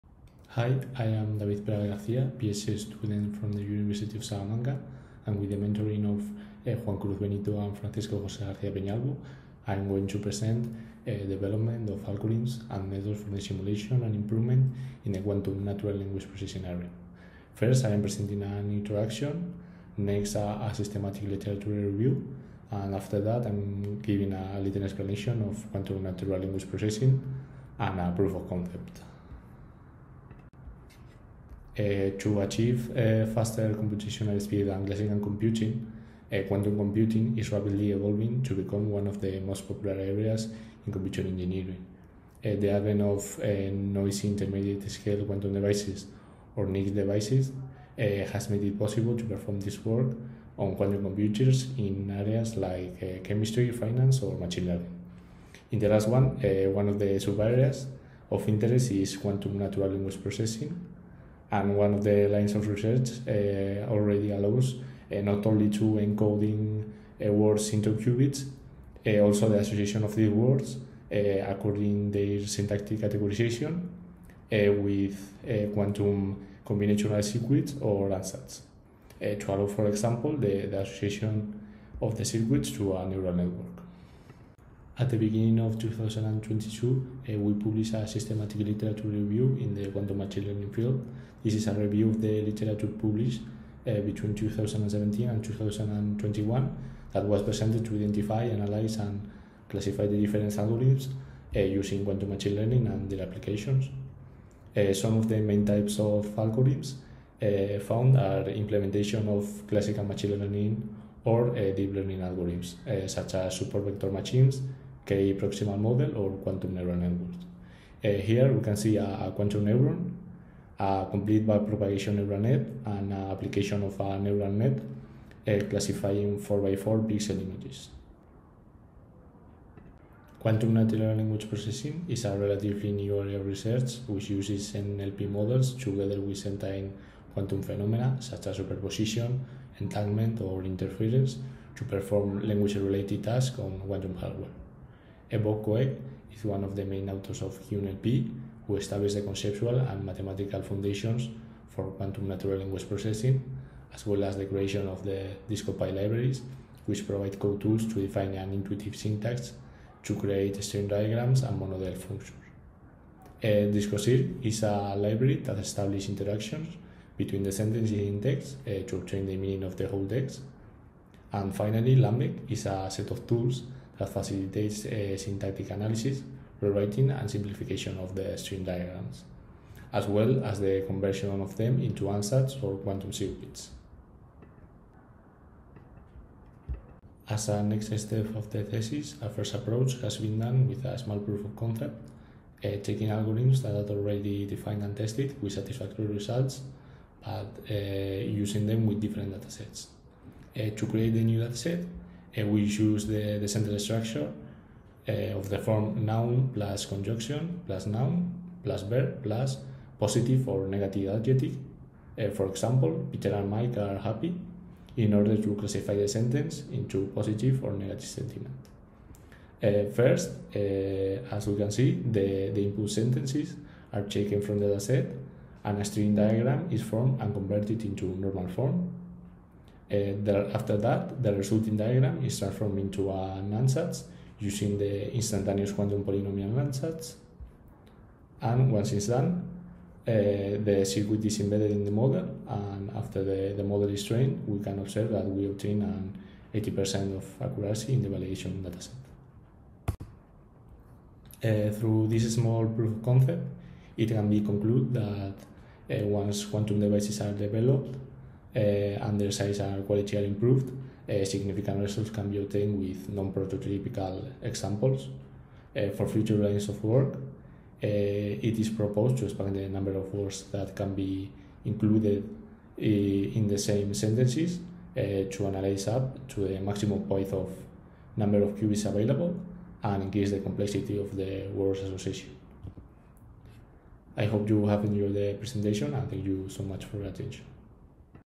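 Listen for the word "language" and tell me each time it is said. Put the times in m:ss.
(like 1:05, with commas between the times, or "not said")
0:15, 0:26, 0:59, 2:11, 2:22, 2:32.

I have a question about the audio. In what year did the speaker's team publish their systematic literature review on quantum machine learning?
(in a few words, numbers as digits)
2022.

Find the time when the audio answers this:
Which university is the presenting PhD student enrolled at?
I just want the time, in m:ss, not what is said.
0:03.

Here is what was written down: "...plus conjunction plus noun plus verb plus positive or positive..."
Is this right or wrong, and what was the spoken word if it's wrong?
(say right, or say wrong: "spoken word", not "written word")
wrong: "negative", not "positive".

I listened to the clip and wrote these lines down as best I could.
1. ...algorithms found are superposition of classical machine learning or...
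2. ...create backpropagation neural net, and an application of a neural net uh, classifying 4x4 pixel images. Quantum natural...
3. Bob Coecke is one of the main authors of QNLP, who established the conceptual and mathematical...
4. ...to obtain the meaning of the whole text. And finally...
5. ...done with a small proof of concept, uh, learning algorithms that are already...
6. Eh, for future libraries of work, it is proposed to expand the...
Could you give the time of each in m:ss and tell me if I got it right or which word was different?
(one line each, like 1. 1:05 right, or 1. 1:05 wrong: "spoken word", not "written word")
1. 1:46 wrong: "implementation", not "superposition"
2. 2:01 wrong: "complete", not "create"
3. 2:25 right
4. 2:48 right
5. 3:10 wrong: "taking", not "learning"
6. 4:25 wrong: "lines", not "libraries".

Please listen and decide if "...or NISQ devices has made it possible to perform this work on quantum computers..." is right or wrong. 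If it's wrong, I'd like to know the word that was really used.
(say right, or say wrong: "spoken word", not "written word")
right.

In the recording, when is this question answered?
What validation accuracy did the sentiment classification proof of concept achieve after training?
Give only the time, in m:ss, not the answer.
4:06.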